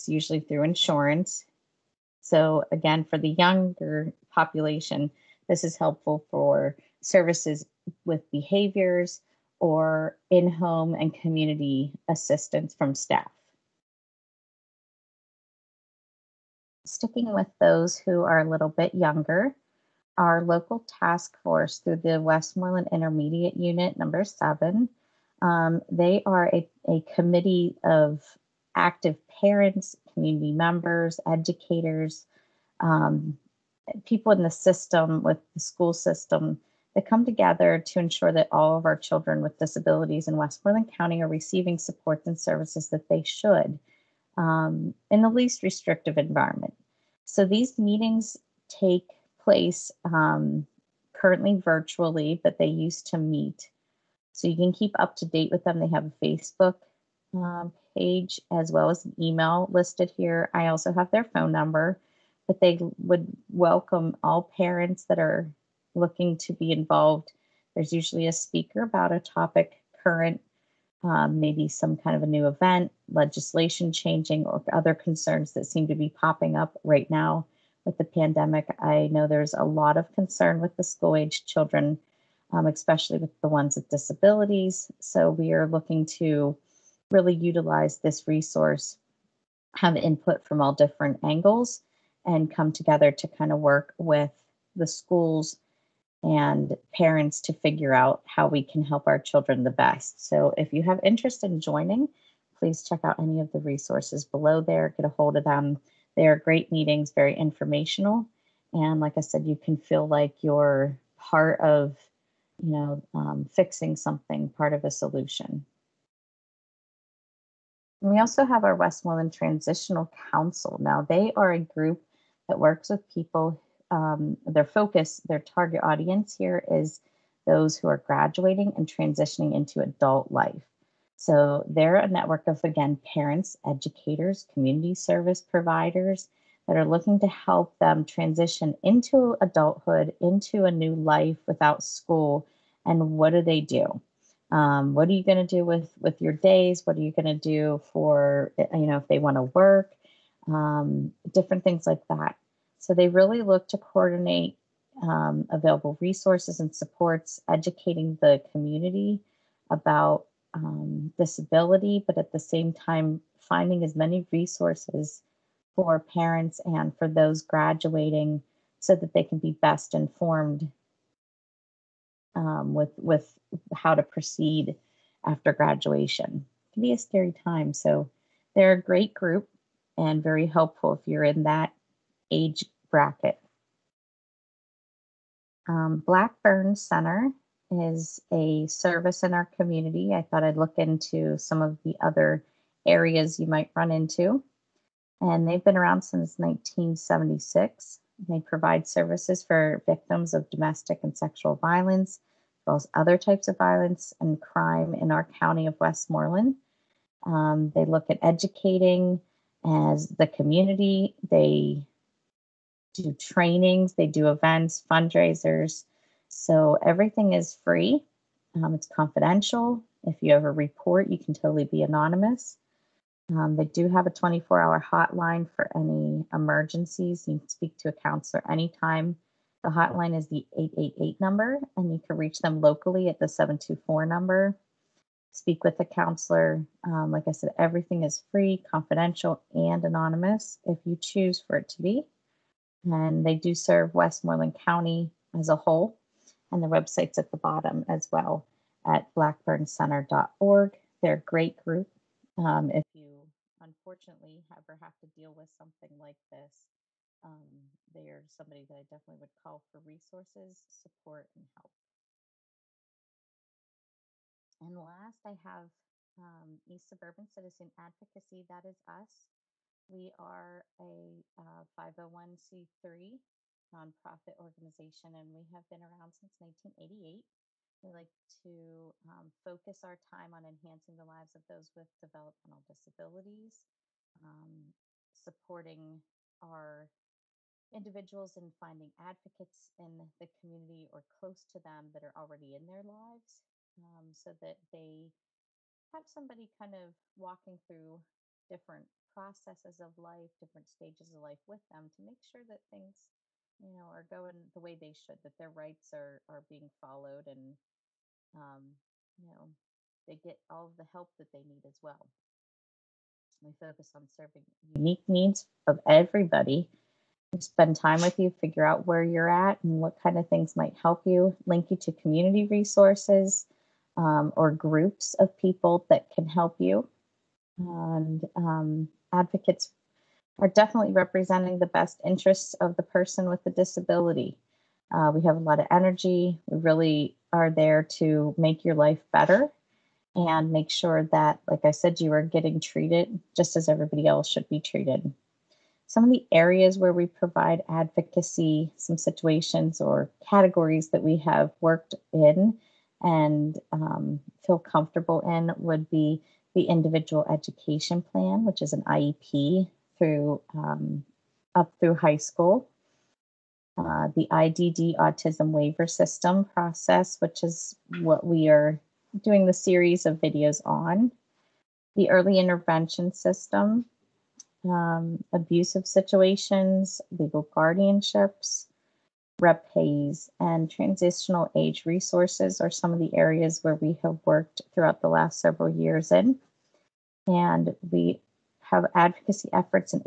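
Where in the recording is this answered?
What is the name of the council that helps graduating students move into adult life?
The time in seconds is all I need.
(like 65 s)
118 s.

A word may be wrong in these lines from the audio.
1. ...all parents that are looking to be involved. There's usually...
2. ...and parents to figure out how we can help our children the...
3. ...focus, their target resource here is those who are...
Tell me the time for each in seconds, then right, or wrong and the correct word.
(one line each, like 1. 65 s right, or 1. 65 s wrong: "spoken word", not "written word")
1. 64 s right
2. 96 s right
3. 124 s wrong: "audience", not "resource".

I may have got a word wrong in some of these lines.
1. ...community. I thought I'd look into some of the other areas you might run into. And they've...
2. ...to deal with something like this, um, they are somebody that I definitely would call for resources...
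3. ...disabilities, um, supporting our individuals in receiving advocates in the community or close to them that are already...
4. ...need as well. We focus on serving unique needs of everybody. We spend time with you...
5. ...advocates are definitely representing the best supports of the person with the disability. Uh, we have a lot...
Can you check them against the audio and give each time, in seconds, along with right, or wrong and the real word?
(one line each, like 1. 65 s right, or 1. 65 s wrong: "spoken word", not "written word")
1. 189 s right
2. 255 s right
3. 282 s wrong: "finding", not "receiving"
4. 311 s right
5. 329 s wrong: "interests", not "supports".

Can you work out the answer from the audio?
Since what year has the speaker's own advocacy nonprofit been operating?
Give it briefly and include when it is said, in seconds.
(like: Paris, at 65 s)
1988, at 276 s.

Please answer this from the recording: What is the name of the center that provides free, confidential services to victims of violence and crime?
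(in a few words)
Blackburn Center.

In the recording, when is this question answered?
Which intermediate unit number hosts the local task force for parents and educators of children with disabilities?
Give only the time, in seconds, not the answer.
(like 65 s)
23 s.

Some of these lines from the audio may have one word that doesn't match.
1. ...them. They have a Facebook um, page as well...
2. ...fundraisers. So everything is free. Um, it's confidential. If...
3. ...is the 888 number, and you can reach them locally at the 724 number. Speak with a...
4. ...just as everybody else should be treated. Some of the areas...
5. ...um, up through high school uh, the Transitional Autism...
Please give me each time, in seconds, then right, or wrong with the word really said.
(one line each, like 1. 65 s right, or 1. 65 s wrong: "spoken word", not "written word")
1. 55 s right
2. 214 s right
3. 230 s right
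4. 343 s right
5. 360 s wrong: "IDD", not "Transitional".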